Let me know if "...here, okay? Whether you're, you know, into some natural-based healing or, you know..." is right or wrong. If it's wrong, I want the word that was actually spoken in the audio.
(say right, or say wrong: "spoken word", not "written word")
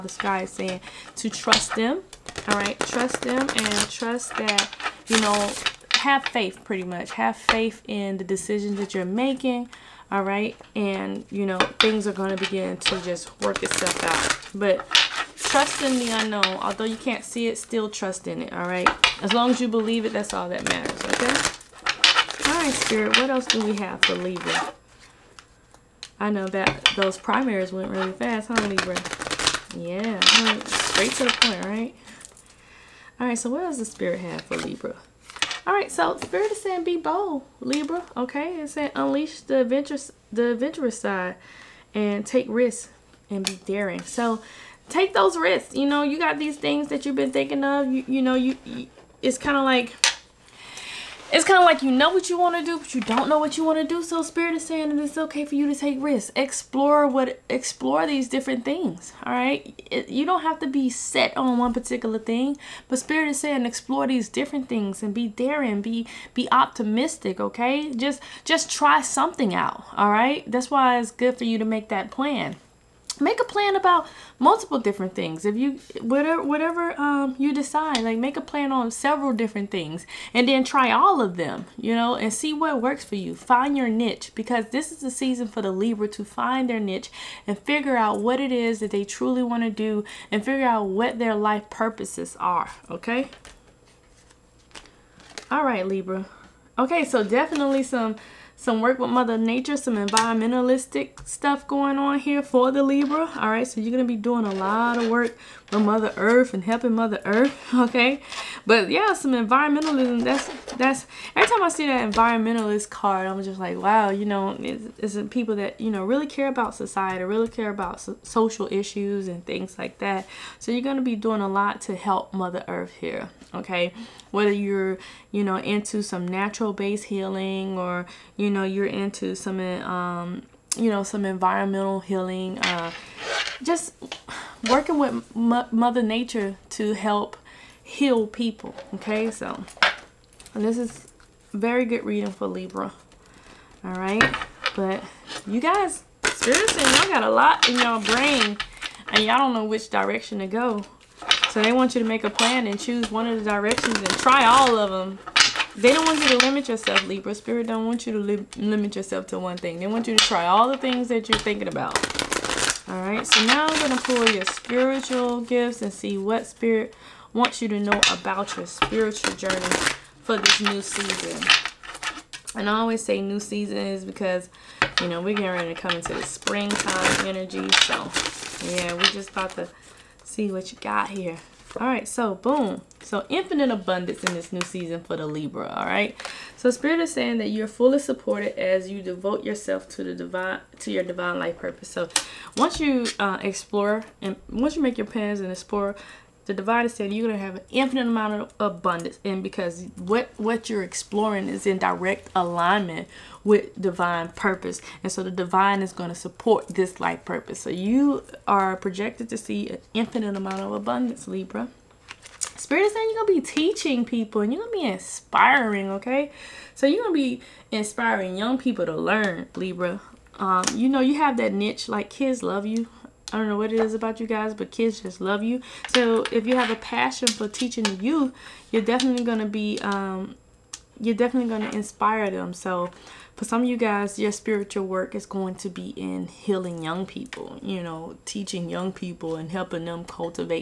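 right.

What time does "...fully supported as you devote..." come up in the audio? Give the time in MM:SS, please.
03:07.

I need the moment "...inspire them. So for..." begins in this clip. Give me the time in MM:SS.
03:51.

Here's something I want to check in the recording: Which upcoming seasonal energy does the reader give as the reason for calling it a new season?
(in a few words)
springtime.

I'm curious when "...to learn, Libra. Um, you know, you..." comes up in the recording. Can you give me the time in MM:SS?
03:38.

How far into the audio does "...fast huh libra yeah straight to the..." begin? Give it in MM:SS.
00:28.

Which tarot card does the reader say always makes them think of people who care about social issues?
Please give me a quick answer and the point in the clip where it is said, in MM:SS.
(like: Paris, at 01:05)
environmentalist card, at 01:52.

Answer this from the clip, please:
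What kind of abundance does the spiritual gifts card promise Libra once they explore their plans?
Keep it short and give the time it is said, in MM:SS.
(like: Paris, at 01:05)
infinite abundance, at 03:03.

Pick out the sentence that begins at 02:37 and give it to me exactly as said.
Spirit don't want you to li limit yourself to one thing.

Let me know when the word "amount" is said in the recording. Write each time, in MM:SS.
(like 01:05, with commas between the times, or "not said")
03:18, 03:30.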